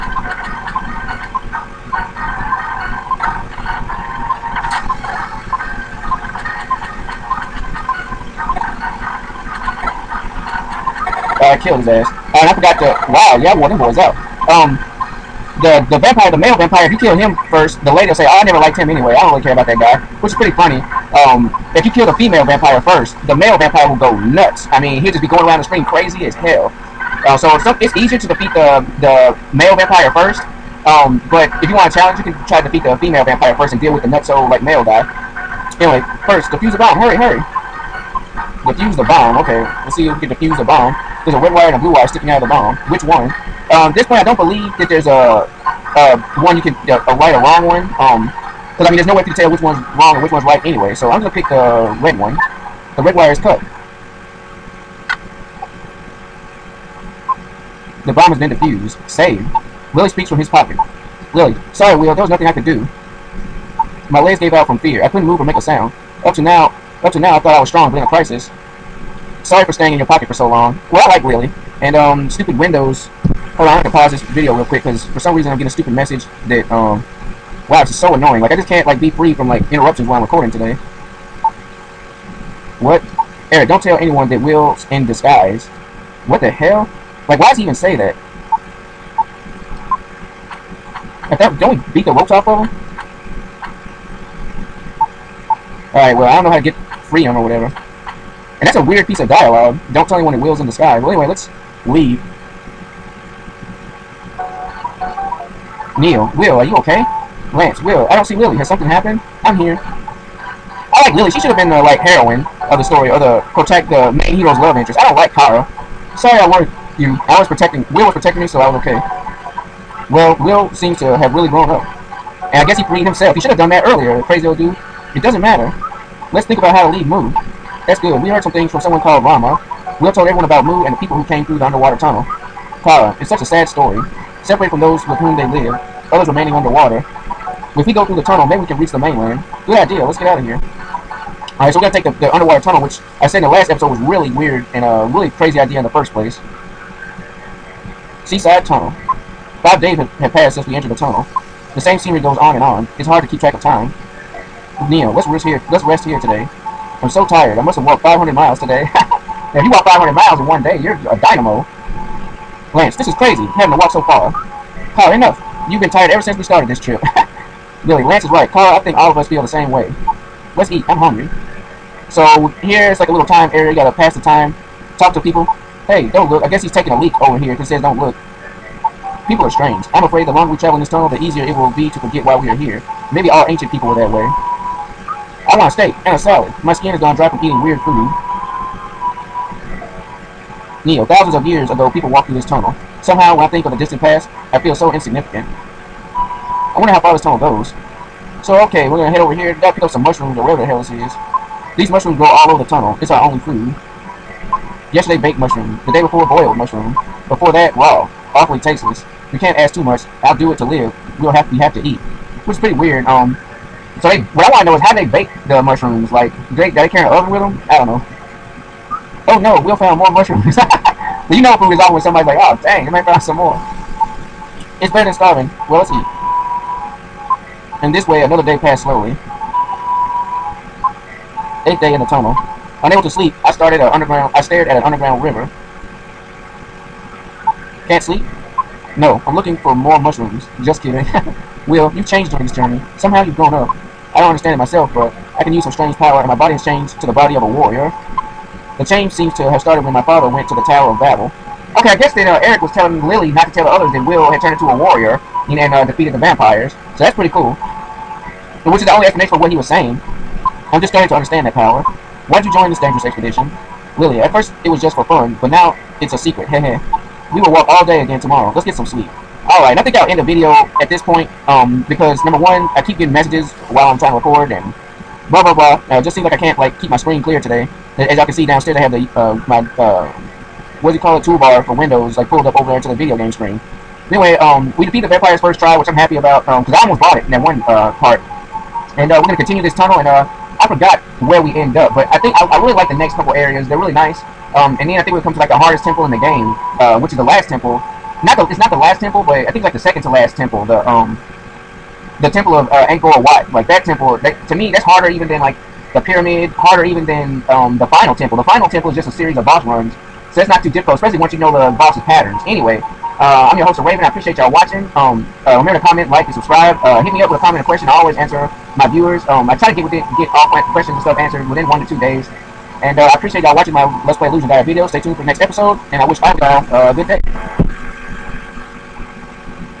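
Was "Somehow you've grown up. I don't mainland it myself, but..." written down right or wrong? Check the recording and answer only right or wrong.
wrong.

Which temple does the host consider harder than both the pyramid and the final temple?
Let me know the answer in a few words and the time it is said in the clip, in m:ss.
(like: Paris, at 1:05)
Angkor Wat, at 5:02.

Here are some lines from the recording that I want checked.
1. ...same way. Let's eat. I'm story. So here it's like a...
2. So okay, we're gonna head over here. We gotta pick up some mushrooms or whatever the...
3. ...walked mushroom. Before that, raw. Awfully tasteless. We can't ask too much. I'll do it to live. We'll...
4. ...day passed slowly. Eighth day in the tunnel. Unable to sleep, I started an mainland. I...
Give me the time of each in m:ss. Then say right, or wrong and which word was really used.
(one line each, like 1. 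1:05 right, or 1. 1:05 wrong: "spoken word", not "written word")
1. 2:49 wrong: "hungry", not "story"
2. 3:18 right
3. 3:26 wrong: "boiled", not "walked"
4. 3:48 wrong: "underground", not "mainland".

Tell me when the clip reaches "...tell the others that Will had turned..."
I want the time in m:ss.
4:13.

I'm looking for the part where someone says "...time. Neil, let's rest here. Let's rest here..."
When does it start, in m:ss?
2:33.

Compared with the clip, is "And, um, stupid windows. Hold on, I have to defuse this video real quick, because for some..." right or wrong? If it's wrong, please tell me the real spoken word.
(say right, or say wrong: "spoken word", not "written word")
wrong: "pause", not "defuse".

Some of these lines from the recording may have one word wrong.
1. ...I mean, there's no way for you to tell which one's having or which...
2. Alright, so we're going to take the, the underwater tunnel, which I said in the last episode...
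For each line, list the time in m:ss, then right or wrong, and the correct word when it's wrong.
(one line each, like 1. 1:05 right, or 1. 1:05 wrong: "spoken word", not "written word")
1. 0:48 wrong: "wrong", not "having"
2. 2:21 right.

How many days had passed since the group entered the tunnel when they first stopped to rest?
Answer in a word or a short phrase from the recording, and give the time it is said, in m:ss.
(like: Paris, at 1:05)
5, at 2:29.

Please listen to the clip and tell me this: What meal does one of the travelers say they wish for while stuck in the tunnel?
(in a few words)
A steak and a salad.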